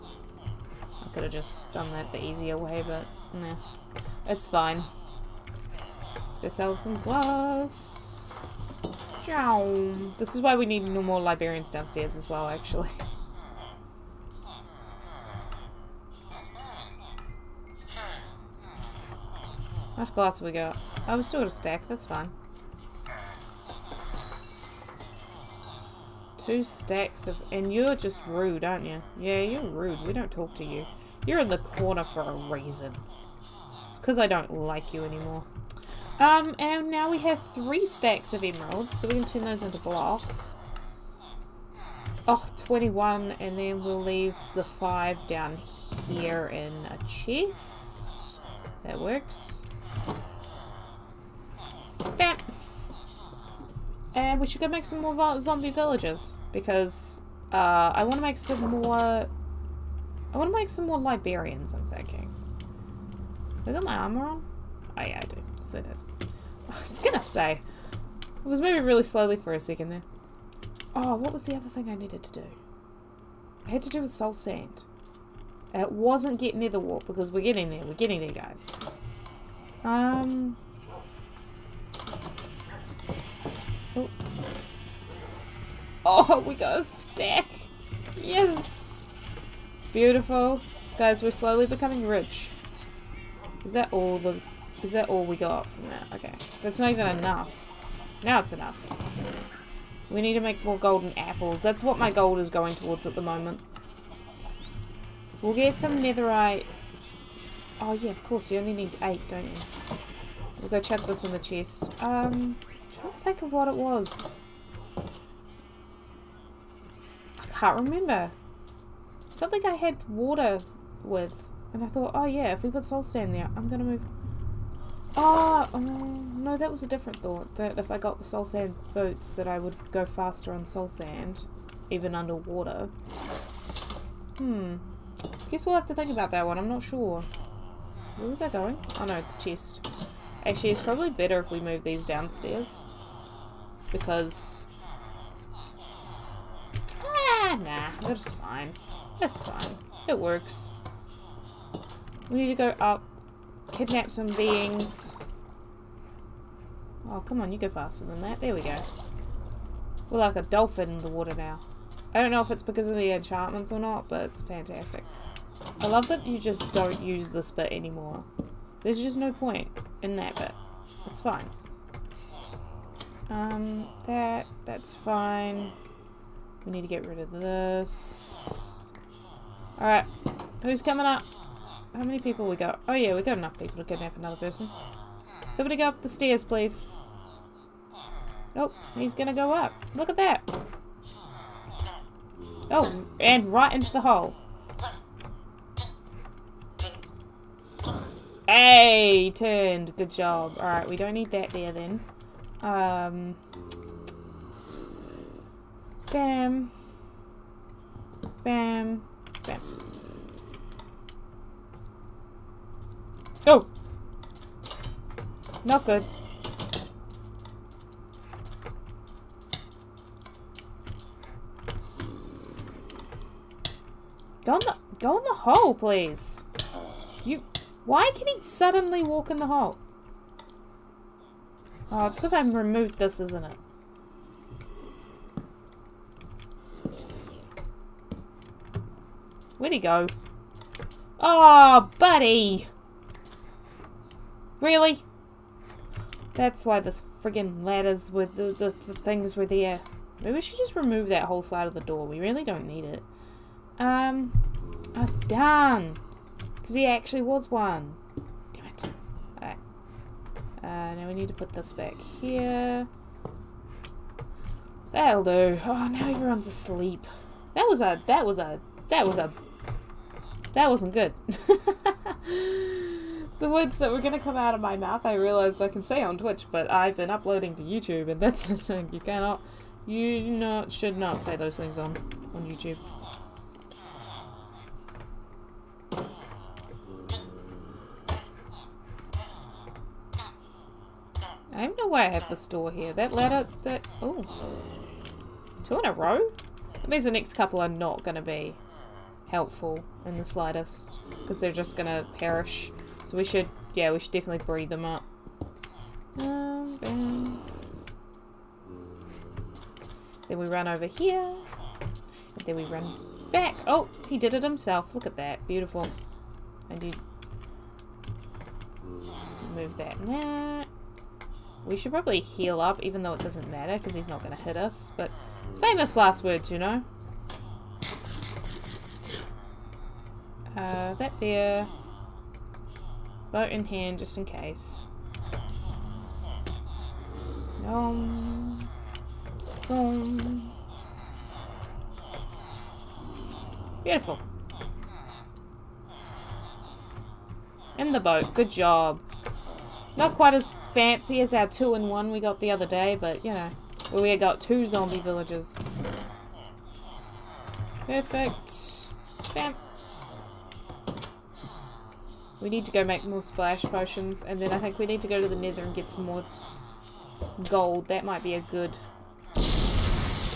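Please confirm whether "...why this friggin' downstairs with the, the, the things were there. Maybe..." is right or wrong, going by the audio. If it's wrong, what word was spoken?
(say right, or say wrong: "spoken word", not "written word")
wrong: "ladders", not "downstairs".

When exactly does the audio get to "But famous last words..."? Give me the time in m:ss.
5:24.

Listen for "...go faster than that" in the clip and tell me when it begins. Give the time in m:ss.
2:37.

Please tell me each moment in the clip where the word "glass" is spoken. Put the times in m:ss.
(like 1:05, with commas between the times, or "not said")
0:07, 0:20.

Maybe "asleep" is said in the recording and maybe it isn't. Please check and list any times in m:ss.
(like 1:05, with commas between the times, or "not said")
4:26.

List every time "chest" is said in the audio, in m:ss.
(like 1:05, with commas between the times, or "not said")
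0:47, 1:51, 2:19.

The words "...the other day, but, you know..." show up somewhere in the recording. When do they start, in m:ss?
5:52.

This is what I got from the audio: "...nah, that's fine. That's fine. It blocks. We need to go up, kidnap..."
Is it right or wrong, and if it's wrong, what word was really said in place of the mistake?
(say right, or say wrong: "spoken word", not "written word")
wrong: "works", not "blocks".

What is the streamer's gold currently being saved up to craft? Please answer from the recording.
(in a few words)
Golden apples.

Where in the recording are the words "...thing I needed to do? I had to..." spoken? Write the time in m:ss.
1:11.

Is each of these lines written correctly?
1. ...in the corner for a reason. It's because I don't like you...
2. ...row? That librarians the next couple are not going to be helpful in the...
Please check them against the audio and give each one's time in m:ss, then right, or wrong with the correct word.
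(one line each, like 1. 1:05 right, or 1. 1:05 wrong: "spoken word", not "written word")
1. 0:31 right
2. 4:55 wrong: "means", not "librarians".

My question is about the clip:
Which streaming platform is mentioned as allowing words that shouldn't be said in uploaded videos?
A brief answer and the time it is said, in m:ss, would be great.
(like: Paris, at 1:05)
Twitch, at 4:36.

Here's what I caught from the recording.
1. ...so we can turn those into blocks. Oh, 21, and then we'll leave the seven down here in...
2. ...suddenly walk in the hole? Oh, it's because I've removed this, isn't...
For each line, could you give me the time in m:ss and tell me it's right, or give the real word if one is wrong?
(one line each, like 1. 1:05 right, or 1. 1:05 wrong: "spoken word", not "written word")
1. 0:39 wrong: "five", not "seven"
2. 3:48 right.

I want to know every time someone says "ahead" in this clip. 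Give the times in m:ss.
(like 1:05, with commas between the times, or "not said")
not said.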